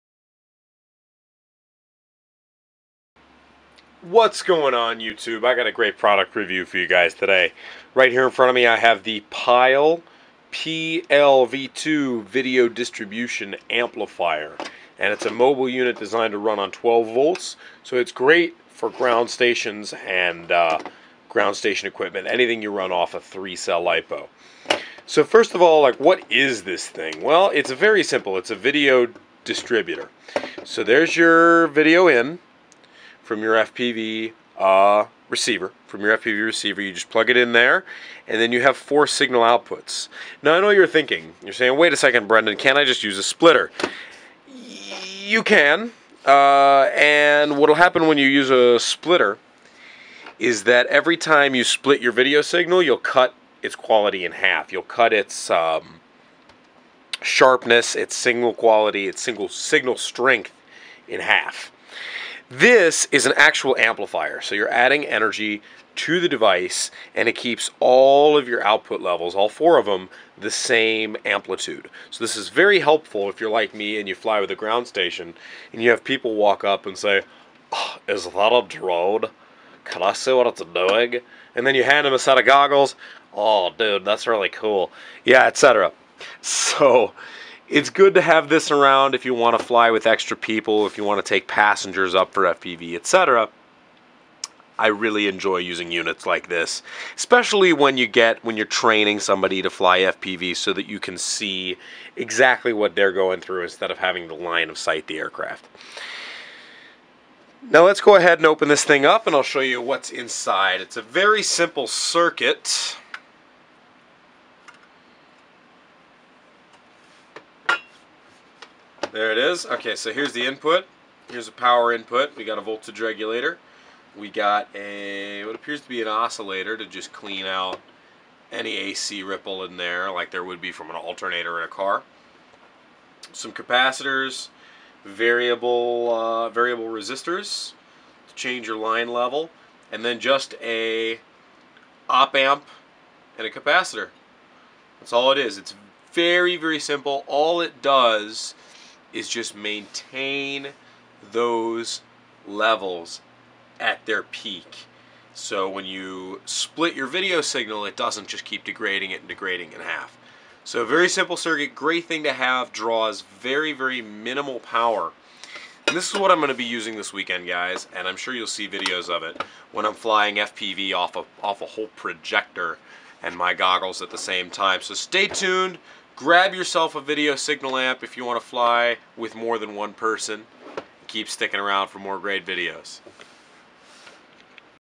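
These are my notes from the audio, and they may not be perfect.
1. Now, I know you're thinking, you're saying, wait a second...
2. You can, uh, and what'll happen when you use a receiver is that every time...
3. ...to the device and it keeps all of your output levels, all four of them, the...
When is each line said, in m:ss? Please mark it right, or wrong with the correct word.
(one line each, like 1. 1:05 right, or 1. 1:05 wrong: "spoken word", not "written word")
1. 0:40 right
2. 0:45 wrong: "splitter", not "receiver"
3. 1:05 right.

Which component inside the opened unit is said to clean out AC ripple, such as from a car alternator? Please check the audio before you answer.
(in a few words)
oscillator.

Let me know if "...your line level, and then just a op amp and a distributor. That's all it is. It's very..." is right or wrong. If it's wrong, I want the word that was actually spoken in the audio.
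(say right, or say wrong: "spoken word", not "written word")
wrong: "capacitor", not "distributor".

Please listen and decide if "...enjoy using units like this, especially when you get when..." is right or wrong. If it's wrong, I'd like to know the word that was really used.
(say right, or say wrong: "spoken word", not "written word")
right.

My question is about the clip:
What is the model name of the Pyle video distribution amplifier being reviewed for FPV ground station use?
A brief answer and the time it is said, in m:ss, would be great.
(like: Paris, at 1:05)
PLV2, at 0:10.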